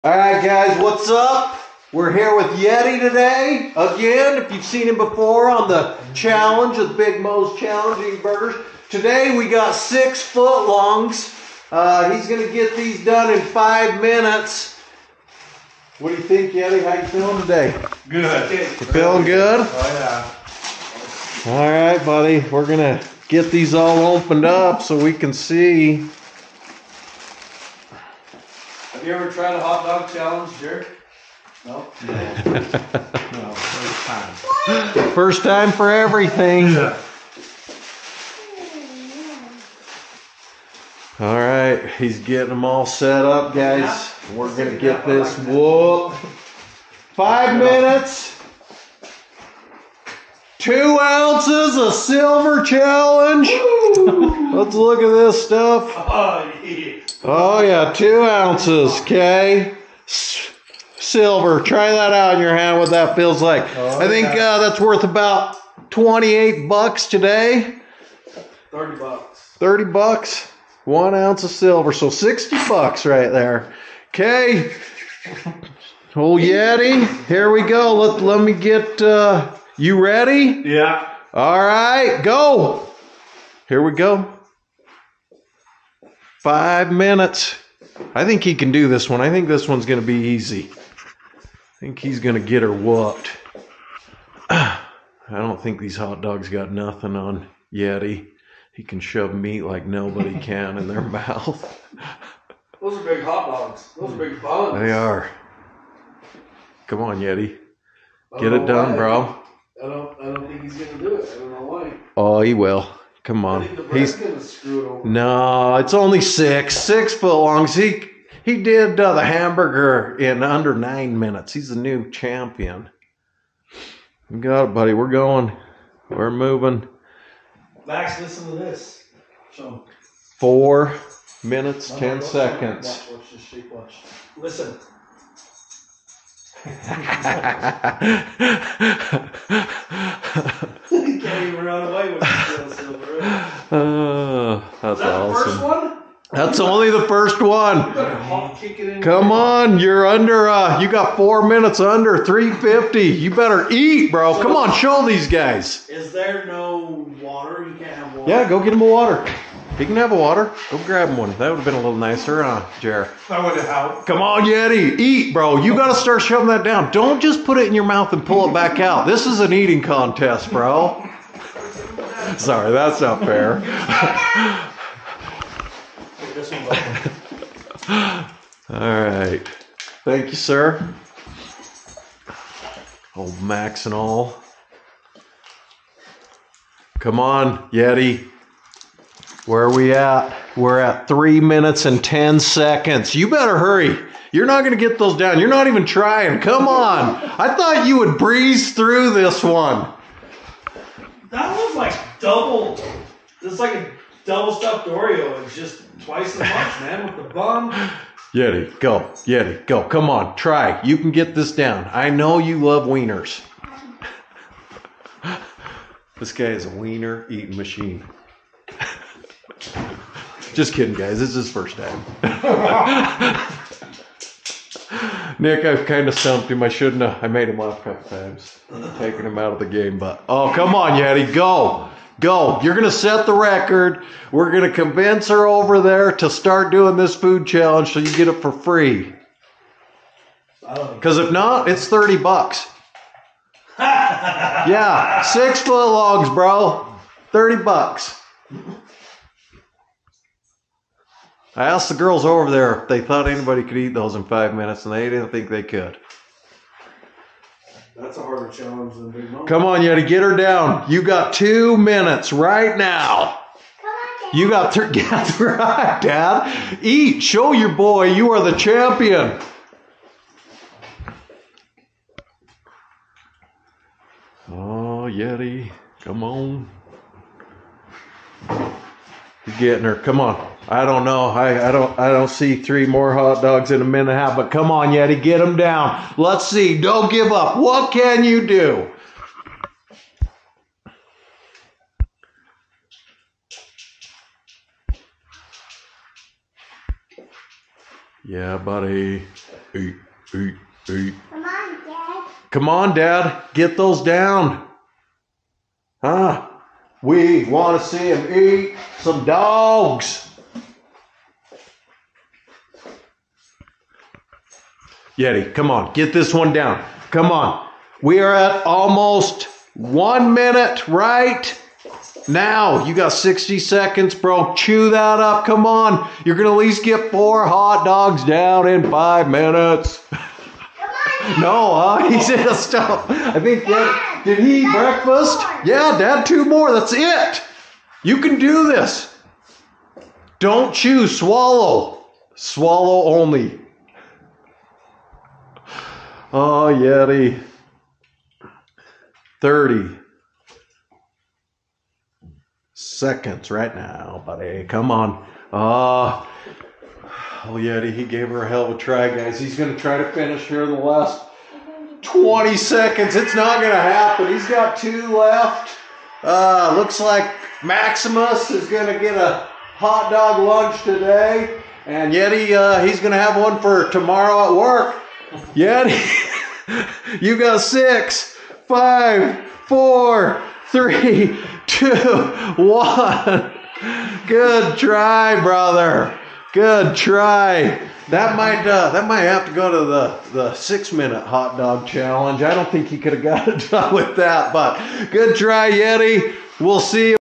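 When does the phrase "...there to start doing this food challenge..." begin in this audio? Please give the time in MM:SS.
03:55.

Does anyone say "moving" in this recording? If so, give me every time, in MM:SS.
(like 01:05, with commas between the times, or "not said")
02:06.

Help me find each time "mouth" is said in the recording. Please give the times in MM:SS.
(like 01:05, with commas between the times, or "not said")
01:41, 02:47.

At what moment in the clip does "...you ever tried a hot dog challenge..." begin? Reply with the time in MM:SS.
00:29.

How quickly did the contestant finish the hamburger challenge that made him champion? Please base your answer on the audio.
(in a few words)
under 9 minutes.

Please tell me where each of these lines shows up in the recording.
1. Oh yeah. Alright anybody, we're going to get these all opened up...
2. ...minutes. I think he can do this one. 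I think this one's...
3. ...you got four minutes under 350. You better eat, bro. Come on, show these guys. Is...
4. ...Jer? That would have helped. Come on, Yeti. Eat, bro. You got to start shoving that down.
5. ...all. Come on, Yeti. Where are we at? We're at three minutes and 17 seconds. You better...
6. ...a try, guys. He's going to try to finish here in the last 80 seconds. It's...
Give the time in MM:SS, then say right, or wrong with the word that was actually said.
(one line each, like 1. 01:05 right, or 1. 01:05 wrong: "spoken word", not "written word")
1. 00:19 wrong: "buddy", not "anybody"
2. 01:26 right
3. 02:30 right
4. 02:42 right
5. 03:03 wrong: "10", not "17"
6. 05:58 wrong: "20", not "80".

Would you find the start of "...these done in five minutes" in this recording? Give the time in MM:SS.
00:12.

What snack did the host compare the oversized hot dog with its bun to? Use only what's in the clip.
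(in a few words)
double stuffed Oreo.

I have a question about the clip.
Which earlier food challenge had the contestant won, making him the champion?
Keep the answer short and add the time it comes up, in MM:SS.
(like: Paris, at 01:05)
Big Mo's Challenging Burgers, at 00:06.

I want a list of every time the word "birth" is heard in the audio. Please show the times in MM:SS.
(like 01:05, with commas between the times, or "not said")
not said.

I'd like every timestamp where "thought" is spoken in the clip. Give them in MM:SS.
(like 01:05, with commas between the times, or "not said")
03:17, 04:13.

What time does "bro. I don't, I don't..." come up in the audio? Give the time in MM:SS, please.
01:48.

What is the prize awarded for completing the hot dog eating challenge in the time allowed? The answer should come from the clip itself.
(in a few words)
2 ounces of silver.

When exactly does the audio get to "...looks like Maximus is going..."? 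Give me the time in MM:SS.
06:06.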